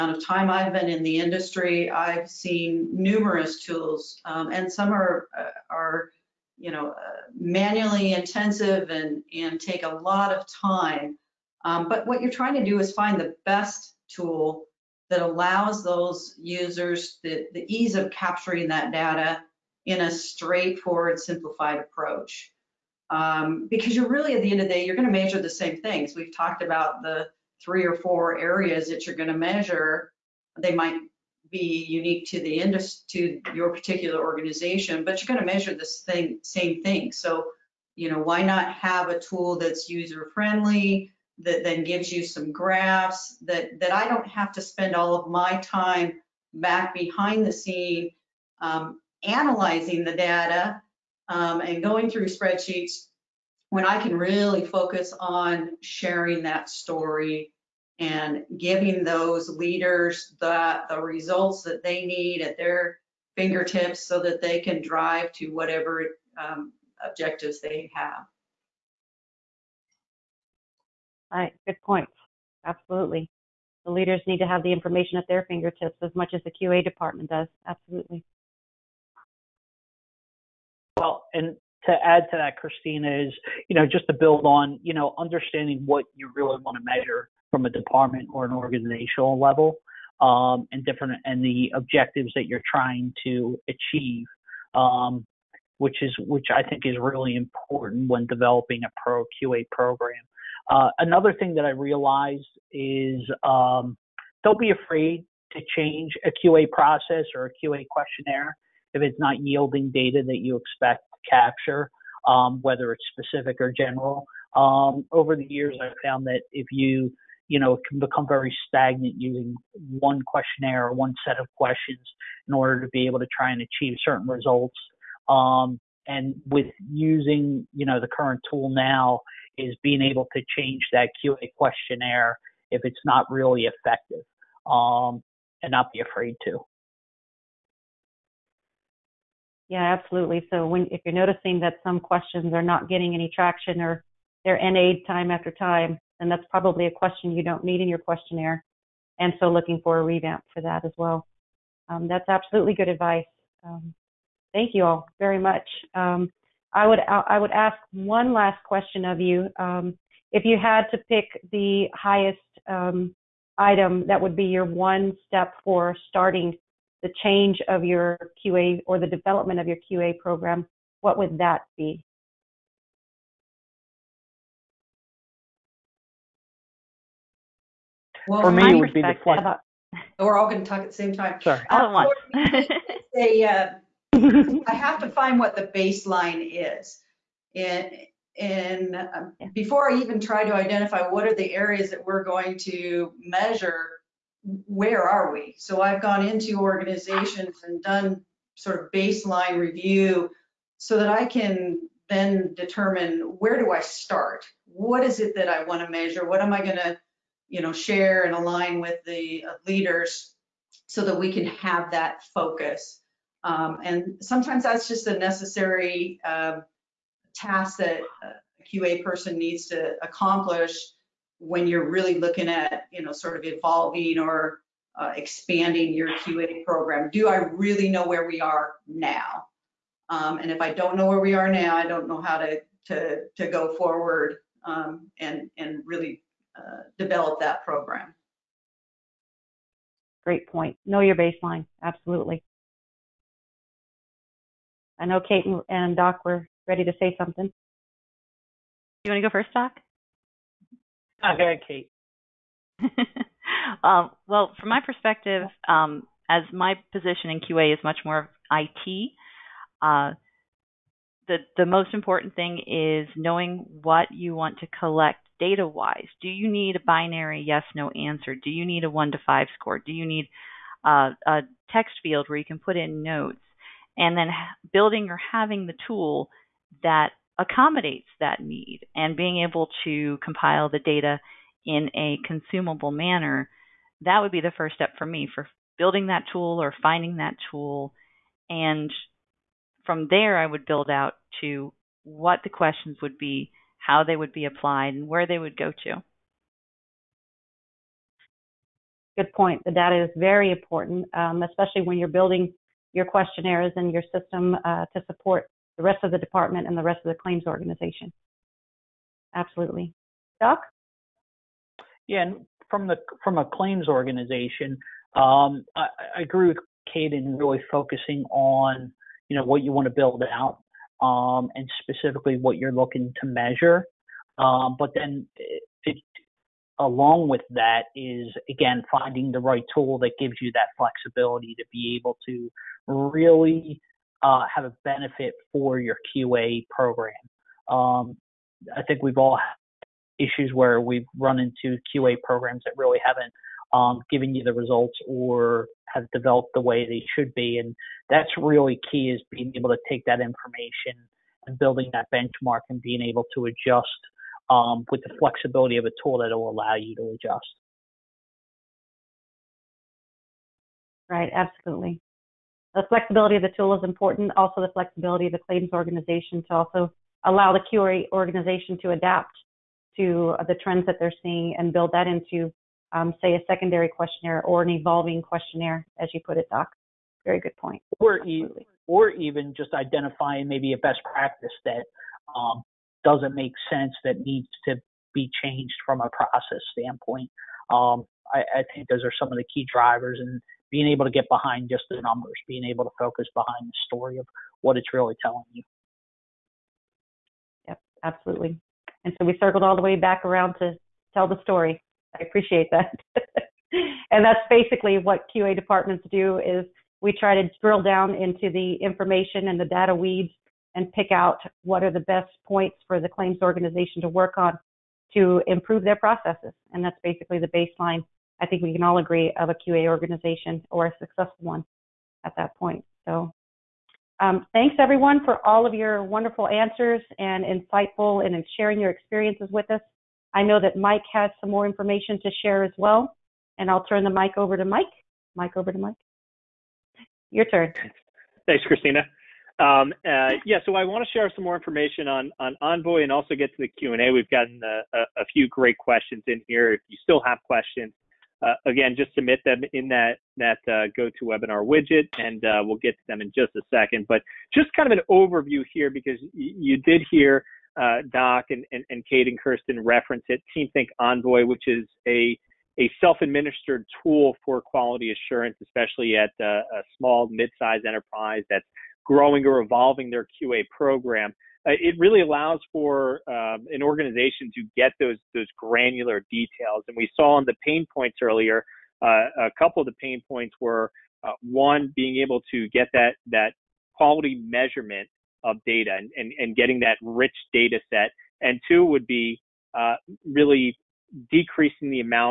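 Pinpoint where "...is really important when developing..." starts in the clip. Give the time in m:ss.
1:36.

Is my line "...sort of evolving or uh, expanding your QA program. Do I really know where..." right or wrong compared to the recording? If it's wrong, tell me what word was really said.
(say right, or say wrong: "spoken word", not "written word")
right.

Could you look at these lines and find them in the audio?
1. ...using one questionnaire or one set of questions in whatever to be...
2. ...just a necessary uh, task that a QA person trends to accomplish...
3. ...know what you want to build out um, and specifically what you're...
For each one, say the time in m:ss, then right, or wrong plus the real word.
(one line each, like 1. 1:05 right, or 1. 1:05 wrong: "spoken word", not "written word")
1. 1:59 wrong: "order", not "whatever"
2. 3:34 wrong: "needs", not "trends"
3. 5:19 right.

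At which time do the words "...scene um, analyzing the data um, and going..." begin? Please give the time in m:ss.
0:47.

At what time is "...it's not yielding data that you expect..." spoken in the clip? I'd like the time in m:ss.
1:49.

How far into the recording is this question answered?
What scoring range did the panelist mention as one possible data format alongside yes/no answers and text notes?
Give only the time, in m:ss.
4:28.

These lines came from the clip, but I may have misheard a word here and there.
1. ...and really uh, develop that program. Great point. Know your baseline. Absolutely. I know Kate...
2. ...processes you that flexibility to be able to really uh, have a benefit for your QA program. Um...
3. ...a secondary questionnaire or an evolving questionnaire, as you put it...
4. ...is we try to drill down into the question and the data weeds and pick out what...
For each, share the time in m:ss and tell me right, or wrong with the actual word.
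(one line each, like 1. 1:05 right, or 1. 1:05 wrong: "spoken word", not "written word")
1. 3:55 right
2. 5:30 wrong: "gives", not "processes"
3. 6:13 right
4. 6:46 wrong: "information", not "question".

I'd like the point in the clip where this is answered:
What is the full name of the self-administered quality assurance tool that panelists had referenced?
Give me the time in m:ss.
7:40.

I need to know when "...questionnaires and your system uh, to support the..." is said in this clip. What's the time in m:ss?
5:03.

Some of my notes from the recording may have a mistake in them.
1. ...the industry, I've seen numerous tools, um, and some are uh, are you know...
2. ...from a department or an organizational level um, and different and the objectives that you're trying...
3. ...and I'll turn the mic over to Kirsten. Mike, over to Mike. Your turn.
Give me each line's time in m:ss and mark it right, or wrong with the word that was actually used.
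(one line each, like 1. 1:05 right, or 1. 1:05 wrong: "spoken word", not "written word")
1. 0:01 right
2. 1:27 right
3. 7:13 wrong: "Mike", not "Kirsten".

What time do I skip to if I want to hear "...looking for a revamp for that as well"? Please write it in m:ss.
2:29.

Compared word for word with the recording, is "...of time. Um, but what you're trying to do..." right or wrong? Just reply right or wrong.
right.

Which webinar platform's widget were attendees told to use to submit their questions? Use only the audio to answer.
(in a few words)
GoToWebinar.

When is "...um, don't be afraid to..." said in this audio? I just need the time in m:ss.
1:43.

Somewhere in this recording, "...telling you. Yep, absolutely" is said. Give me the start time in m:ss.
6:35.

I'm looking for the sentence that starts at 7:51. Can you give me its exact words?
Uh, it really allows for um, an organization to get those those granular details.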